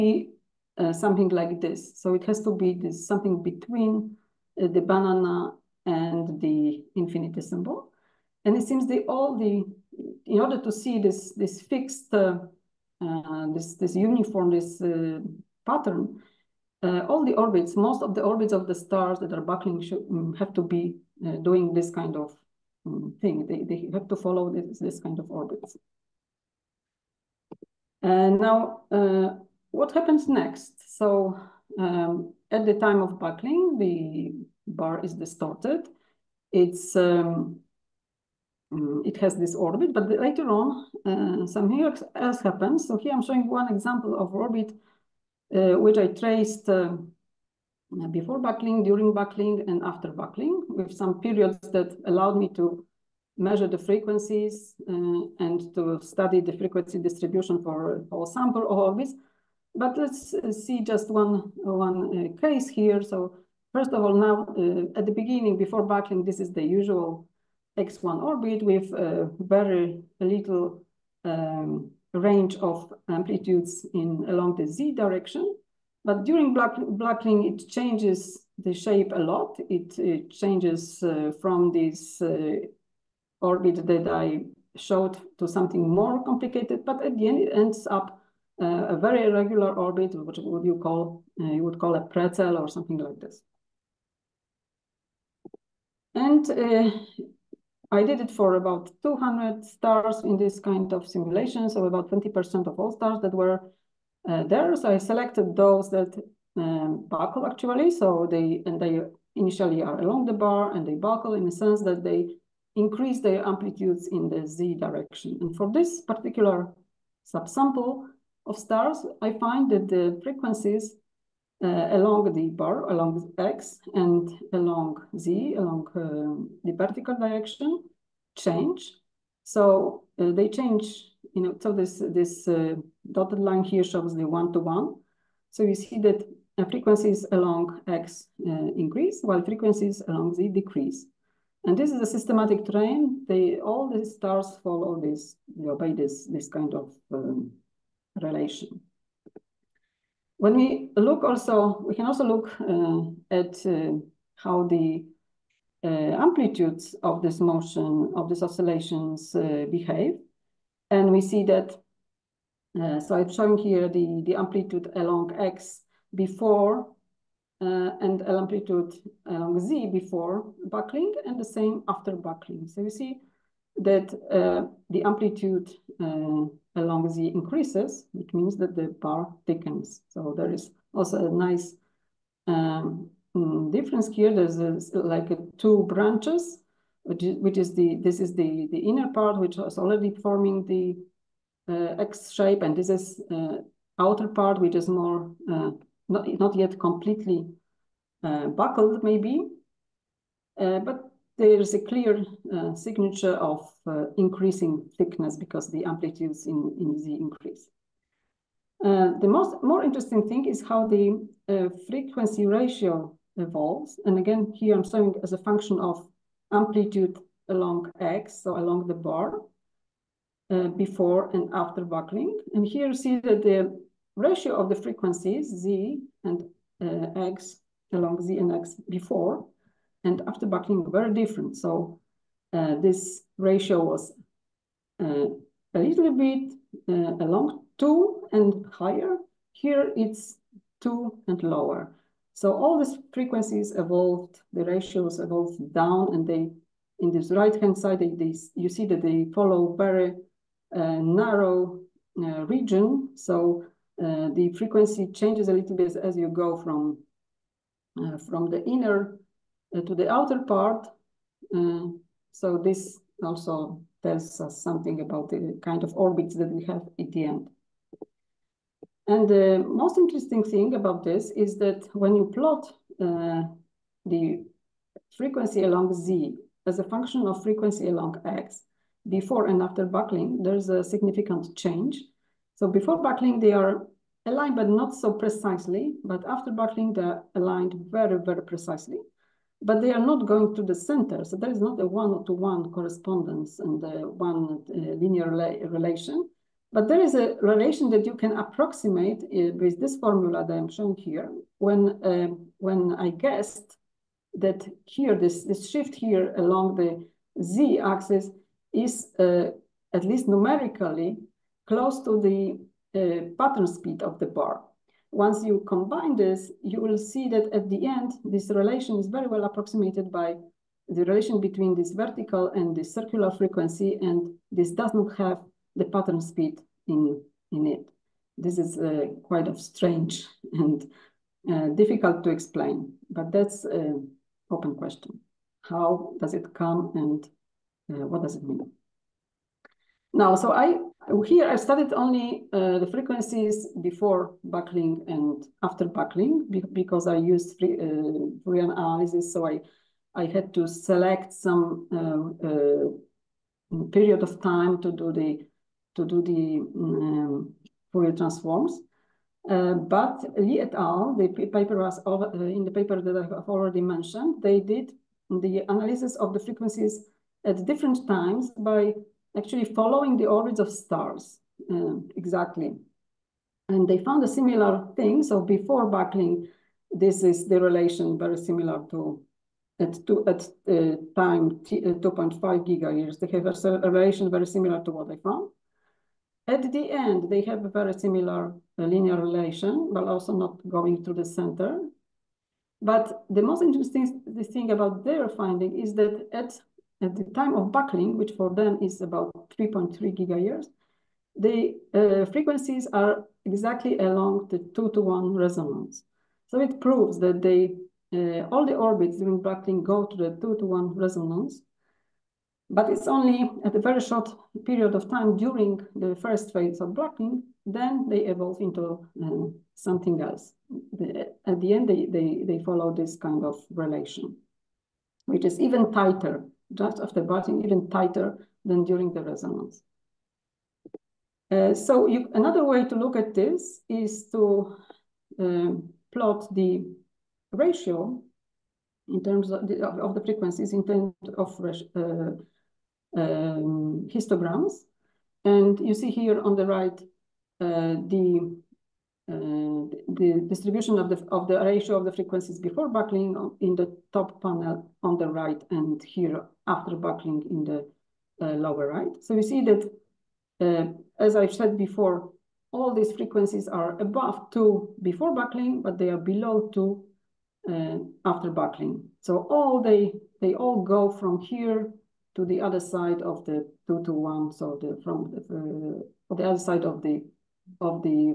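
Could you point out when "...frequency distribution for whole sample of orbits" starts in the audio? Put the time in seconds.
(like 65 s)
56 s.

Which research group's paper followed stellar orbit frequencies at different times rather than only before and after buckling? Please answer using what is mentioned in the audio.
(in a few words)
Li et al.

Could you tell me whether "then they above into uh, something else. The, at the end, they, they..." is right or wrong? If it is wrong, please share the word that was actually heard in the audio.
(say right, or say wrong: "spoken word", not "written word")
wrong: "evolve", not "above".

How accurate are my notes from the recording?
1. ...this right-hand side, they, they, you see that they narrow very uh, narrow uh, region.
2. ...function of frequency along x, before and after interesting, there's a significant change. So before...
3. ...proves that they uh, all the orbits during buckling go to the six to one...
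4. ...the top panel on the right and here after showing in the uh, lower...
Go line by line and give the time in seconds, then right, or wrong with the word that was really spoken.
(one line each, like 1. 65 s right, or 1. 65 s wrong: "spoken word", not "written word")
1. 247 s wrong: "follow", not "narrow"
2. 276 s wrong: "buckling", not "interesting"
3. 406 s wrong: "two", not "six"
4. 453 s wrong: "buckling", not "showing".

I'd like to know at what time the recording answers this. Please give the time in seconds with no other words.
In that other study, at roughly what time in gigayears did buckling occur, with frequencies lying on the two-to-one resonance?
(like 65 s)
399 s.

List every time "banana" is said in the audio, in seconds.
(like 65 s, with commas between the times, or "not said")
4 s.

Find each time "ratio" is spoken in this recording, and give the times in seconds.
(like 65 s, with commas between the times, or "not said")
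212 s, 224 s, 233 s, 244 s, 437 s, 451 s.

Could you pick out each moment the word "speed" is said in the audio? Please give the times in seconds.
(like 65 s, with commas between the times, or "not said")
313 s, 326 s.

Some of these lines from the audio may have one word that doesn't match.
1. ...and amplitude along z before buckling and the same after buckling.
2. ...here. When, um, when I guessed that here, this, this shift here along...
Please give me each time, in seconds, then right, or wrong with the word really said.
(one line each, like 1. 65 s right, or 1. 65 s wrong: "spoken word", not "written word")
1. 168 s right
2. 300 s right.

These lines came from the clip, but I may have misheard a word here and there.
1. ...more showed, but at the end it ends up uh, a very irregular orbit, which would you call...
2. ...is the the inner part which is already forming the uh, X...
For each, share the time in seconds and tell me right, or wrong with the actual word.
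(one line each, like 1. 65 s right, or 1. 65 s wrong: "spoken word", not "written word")
1. 85 s wrong: "complicated", not "showed"
2. 188 s right.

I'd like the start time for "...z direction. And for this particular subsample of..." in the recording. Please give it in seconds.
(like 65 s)
114 s.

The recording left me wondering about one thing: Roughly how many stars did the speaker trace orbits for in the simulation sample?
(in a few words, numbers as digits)
200.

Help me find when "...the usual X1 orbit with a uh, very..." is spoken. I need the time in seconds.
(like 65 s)
66 s.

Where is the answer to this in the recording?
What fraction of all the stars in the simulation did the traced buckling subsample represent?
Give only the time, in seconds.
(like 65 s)
102 s.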